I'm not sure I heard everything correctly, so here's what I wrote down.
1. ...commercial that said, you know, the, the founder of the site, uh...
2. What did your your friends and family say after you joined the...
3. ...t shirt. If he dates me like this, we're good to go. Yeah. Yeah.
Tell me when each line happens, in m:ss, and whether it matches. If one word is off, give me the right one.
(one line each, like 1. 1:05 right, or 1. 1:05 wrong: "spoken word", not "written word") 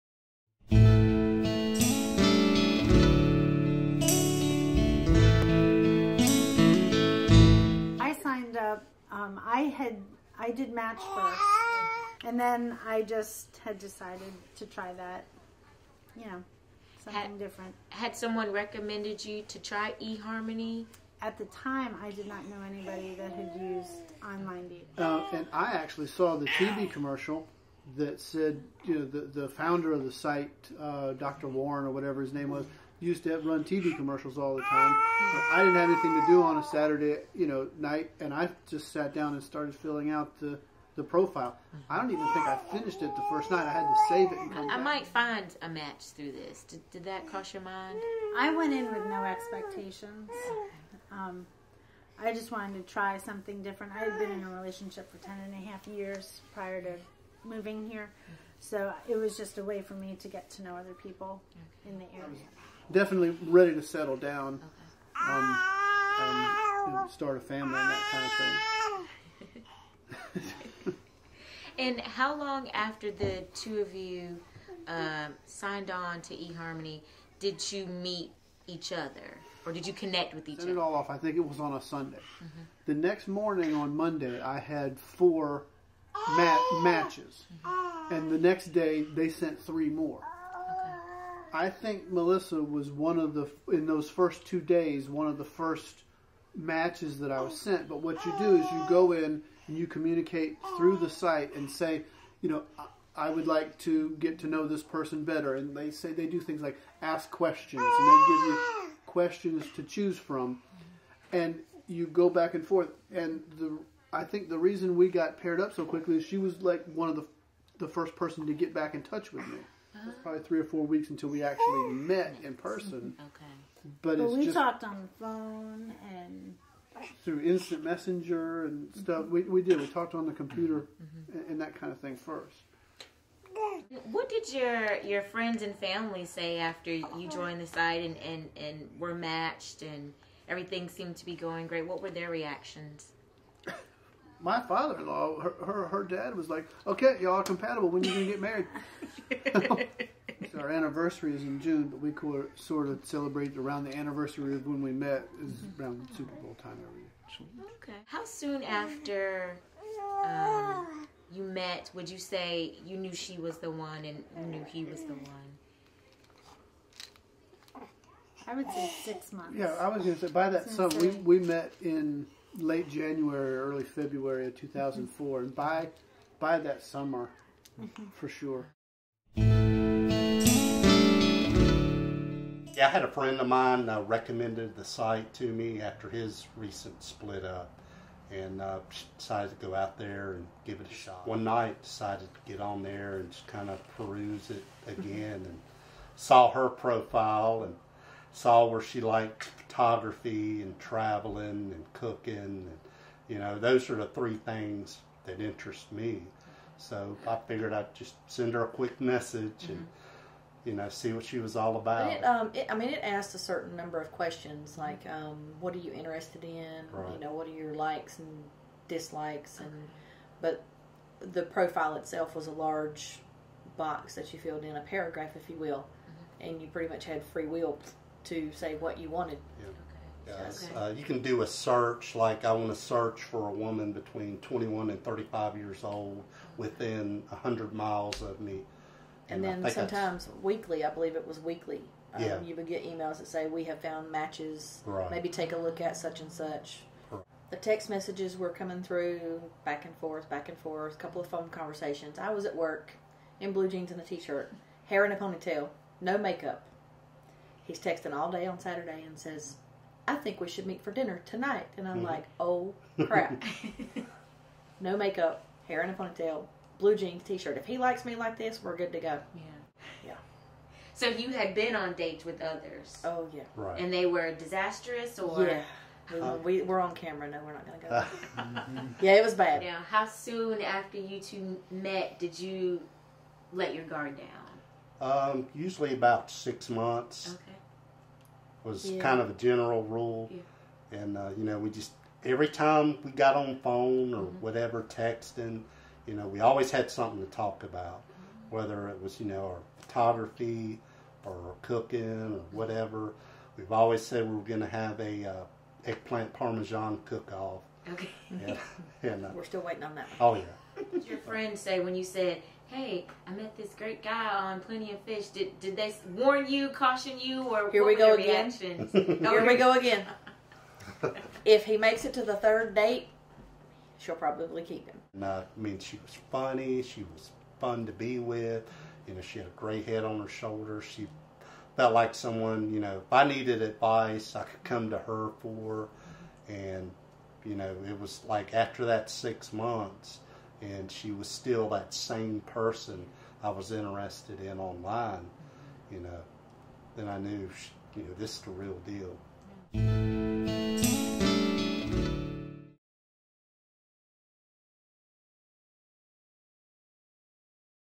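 1. 0:26 right
2. 2:14 right
3. 4:27 wrong: "likes", not "dates".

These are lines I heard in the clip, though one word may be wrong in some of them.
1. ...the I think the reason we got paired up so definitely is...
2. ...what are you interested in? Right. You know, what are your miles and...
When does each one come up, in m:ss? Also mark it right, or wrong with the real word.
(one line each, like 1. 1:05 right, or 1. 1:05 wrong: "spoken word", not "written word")
1. 1:53 wrong: "quickly", not "definitely"
2. 3:35 wrong: "likes", not "miles".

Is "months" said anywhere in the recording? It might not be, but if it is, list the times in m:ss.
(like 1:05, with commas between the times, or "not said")
2:49, 4:46, 5:39.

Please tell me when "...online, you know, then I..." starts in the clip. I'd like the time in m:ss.
5:44.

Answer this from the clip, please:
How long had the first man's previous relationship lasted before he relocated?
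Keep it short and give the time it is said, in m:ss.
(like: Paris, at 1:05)
10 and a half years, at 0:55.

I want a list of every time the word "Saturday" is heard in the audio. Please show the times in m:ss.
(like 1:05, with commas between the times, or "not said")
0:36, 4:18.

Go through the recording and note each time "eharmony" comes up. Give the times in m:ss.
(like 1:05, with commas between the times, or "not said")
0:20, 1:16.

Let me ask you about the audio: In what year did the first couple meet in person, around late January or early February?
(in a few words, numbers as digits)
2004.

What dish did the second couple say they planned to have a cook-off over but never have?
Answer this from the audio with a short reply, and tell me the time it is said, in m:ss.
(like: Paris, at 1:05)
Eggplant parmesan, at 5:05.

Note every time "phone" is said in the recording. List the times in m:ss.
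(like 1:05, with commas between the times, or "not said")
2:05, 4:11, 4:53.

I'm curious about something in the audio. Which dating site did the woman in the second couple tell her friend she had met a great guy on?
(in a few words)
Plenty of Fish.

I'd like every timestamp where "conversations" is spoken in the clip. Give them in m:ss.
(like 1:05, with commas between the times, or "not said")
4:11.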